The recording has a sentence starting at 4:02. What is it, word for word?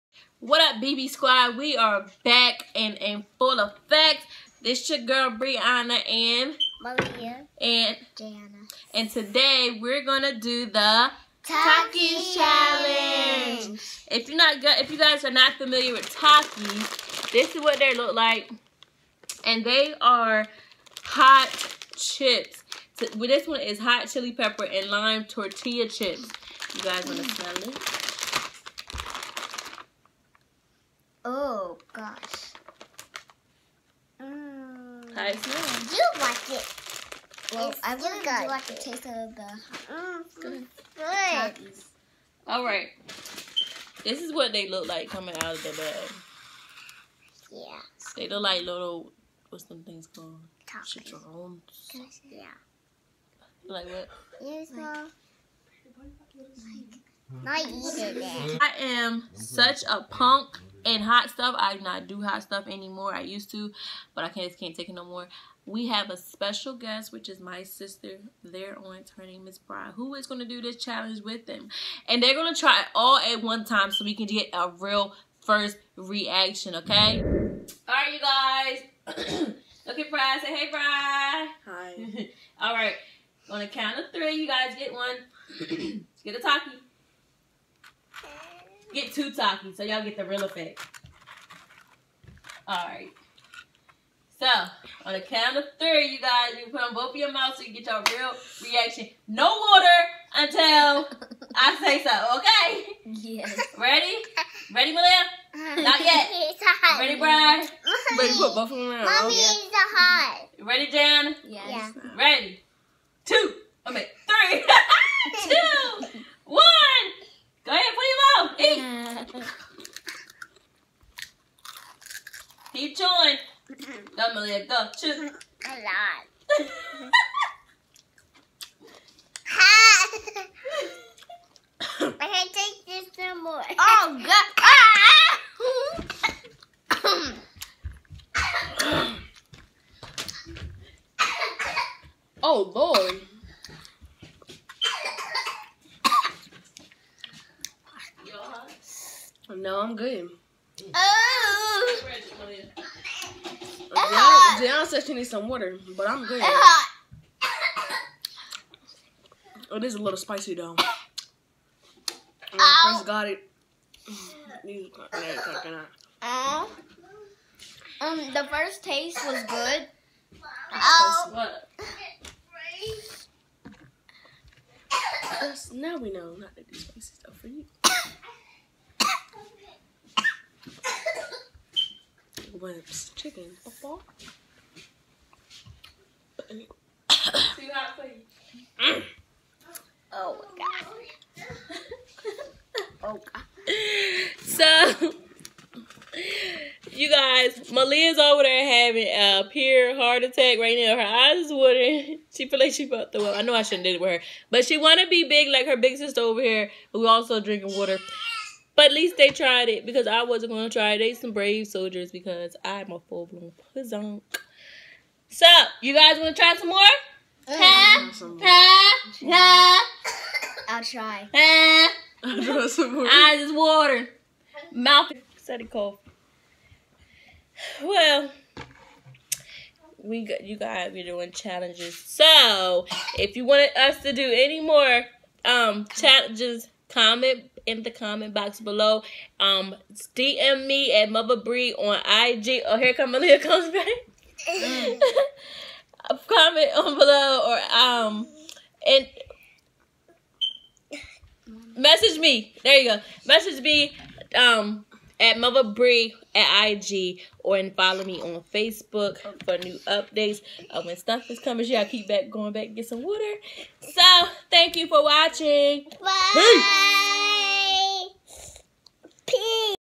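Oh, here come Malia comes back.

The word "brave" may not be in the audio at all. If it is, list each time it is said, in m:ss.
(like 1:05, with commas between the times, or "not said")
3:31.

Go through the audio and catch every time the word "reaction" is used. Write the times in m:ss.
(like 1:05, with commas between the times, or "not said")
1:15, 1:38.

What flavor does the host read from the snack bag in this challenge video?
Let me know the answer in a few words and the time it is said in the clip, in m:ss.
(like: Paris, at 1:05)
Hot chili pepper and lime, at 0:23.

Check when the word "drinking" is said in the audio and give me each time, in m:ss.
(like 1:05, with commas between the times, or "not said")
3:27.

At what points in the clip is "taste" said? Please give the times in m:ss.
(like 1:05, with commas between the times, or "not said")
0:38, 2:48.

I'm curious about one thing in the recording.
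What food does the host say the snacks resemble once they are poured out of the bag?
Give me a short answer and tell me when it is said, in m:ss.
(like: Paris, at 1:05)
Chicharrones, at 0:50.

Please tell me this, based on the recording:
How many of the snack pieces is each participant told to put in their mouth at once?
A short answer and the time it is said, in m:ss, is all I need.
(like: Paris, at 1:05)
2, at 1:29.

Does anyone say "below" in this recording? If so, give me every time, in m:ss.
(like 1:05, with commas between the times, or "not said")
3:58, 4:06.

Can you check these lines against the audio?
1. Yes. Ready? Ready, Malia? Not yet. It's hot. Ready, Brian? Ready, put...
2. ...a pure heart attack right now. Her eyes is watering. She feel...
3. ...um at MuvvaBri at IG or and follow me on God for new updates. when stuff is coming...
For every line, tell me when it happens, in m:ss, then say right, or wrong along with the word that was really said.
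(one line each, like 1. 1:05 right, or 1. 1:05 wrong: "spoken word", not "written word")
1. 1:43 right
2. 3:19 right
3. 4:14 wrong: "Facebook", not "God".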